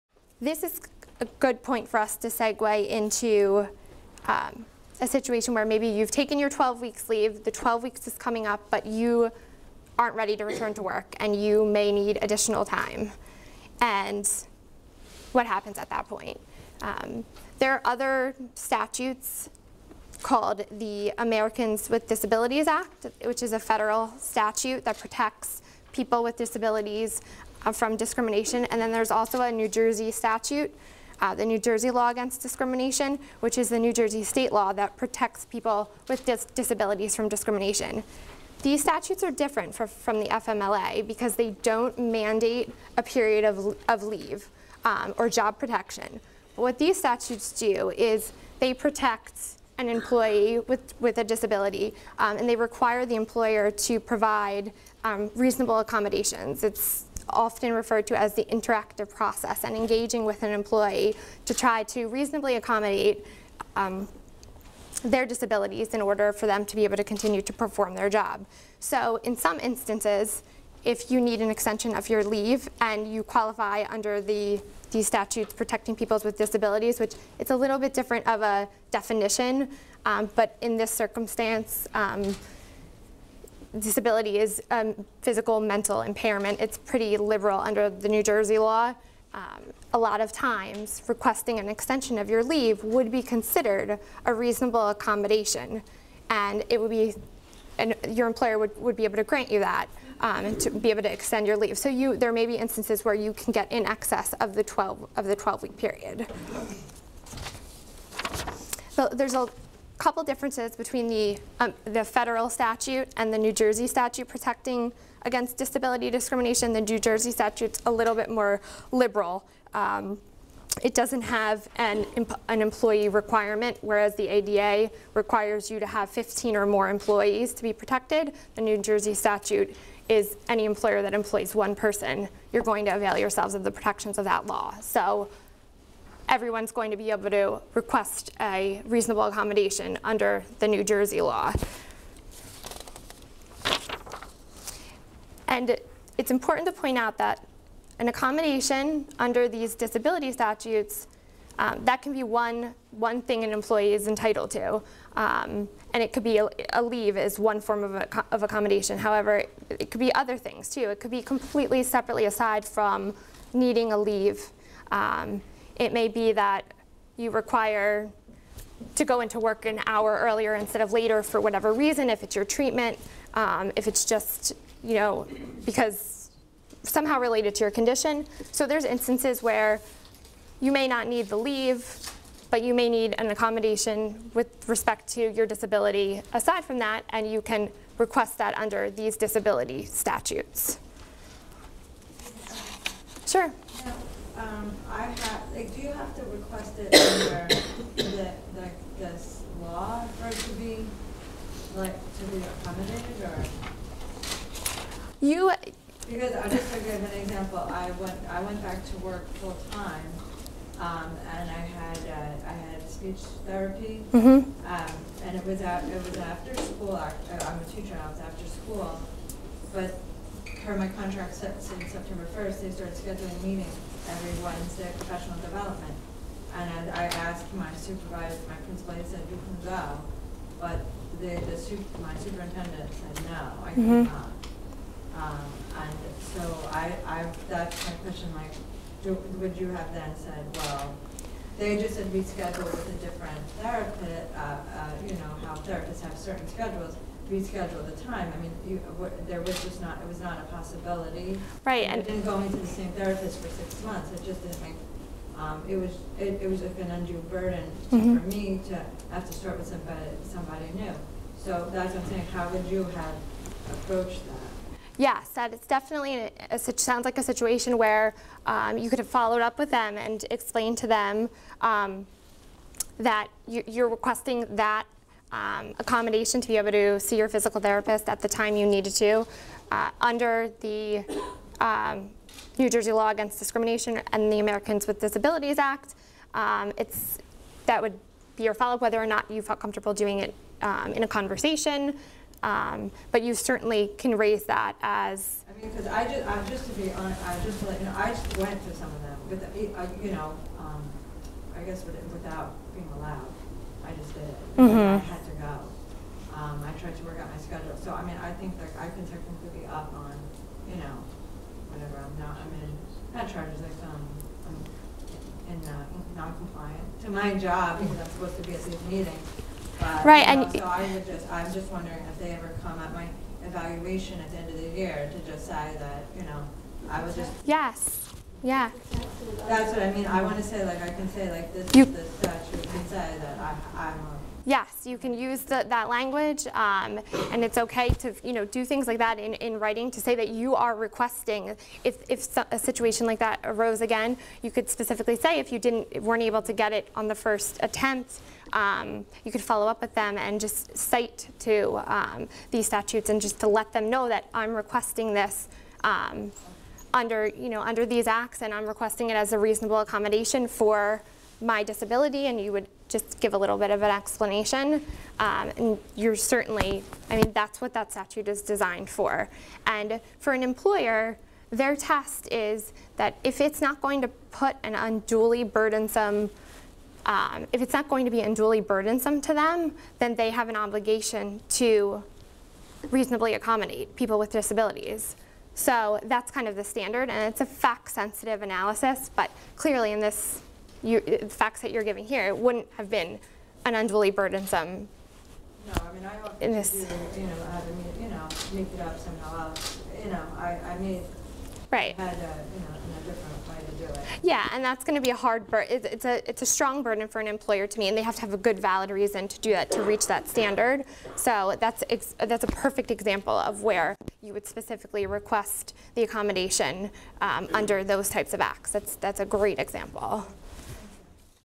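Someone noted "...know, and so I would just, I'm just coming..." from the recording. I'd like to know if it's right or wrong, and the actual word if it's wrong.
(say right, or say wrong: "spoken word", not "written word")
wrong: "wondering", not "coming".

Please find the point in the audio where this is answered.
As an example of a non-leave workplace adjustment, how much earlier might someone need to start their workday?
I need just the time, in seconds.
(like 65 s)
169 s.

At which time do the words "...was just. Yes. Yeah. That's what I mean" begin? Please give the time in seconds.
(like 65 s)
327 s.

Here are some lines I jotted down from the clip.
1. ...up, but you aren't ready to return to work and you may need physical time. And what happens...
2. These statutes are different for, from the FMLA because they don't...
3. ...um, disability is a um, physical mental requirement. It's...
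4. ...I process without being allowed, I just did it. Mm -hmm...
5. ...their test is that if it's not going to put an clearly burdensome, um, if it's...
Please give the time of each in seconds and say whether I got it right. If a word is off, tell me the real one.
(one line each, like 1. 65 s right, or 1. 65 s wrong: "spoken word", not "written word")
1. 8 s wrong: "additional", not "physical"
2. 38 s right
3. 81 s wrong: "impairment", not "requirement"
4. 301 s wrong: "guess", not "process"
5. 371 s wrong: "unduly", not "clearly".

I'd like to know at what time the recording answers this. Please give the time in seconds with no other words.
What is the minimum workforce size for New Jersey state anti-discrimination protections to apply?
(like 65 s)
131 s.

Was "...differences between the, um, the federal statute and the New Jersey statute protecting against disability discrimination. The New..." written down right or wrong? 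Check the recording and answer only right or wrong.
right.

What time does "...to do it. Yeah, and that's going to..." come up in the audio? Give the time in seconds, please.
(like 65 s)
403 s.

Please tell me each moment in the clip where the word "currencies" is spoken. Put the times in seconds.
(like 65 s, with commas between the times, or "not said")
not said.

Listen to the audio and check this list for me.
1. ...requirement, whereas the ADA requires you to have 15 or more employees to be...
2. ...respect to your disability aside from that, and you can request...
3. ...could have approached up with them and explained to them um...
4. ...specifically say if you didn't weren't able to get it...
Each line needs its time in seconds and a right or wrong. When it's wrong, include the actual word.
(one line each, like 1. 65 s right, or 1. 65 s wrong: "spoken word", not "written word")
1. 123 s right
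2. 184 s right
3. 268 s wrong: "followed", not "approached"
4. 344 s right.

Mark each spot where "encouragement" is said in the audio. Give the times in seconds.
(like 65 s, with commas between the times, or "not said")
not said.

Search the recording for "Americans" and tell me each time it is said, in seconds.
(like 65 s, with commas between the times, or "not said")
21 s, 284 s.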